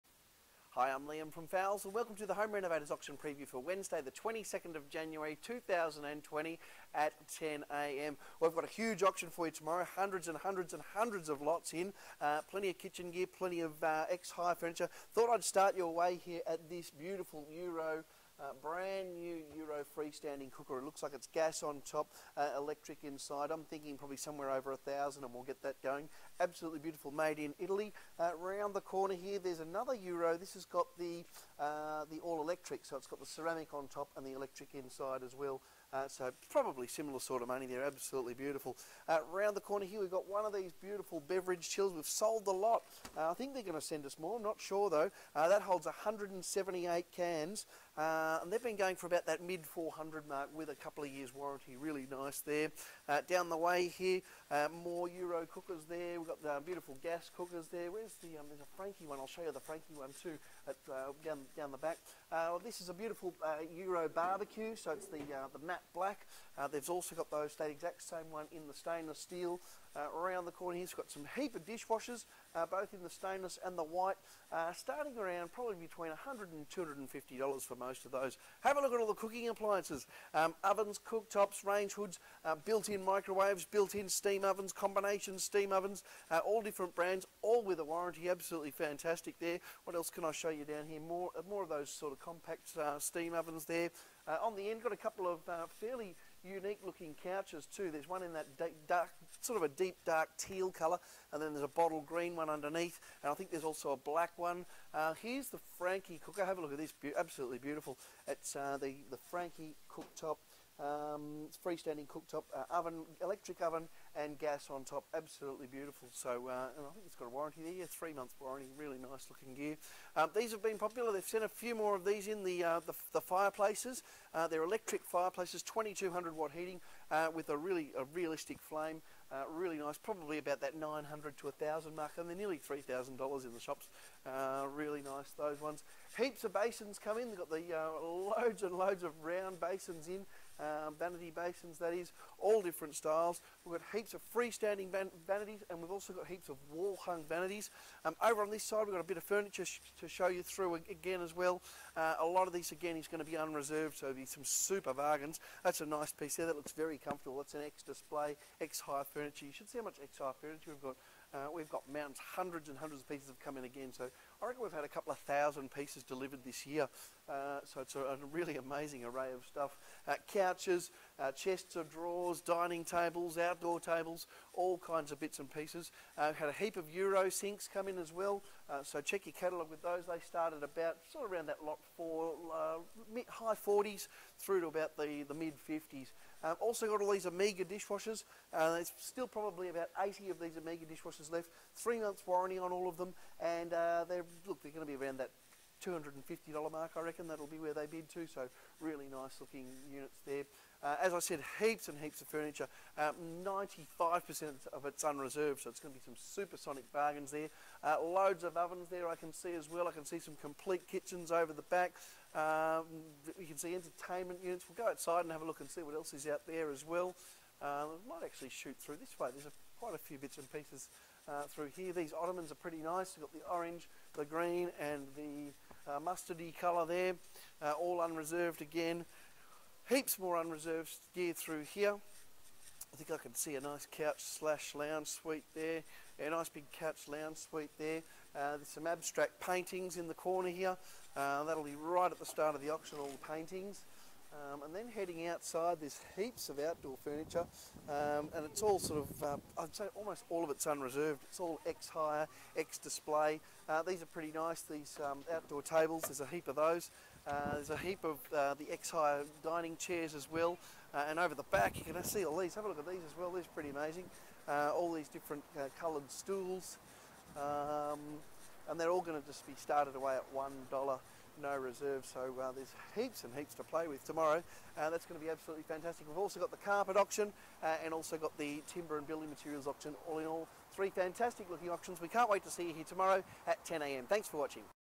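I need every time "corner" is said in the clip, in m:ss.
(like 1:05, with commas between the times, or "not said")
0:28, 0:39, 1:10, 4:00.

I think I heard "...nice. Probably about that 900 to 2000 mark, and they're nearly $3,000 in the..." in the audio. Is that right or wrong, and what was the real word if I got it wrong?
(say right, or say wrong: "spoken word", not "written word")
wrong: "1000", not "2000".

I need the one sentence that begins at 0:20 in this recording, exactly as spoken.
It looks like it's gas on top, uh, electric inside.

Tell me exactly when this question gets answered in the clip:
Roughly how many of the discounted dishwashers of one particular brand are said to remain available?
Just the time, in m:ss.
3:09.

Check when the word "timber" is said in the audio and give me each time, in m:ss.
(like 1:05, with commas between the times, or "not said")
4:38.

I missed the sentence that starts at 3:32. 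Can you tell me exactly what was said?
Um, you can see entertainment units.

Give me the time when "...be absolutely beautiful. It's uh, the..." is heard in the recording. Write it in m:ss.
1:46.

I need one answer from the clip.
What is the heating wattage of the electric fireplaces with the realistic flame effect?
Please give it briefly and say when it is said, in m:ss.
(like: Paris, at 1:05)
2200 watt, at 2:05.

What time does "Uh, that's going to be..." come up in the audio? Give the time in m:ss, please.
4:34.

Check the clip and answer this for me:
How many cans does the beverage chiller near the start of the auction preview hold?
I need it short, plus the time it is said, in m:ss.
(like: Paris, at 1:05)
178, at 0:45.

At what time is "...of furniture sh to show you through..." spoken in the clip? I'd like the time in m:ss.
2:29.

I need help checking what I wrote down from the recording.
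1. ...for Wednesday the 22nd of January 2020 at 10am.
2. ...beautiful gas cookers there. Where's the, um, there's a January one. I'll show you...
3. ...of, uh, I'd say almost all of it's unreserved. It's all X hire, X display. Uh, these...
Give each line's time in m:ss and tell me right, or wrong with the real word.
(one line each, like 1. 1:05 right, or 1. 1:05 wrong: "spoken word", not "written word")
1. 0:03 right
2. 0:56 wrong: "Franke", not "January"
3. 4:09 right.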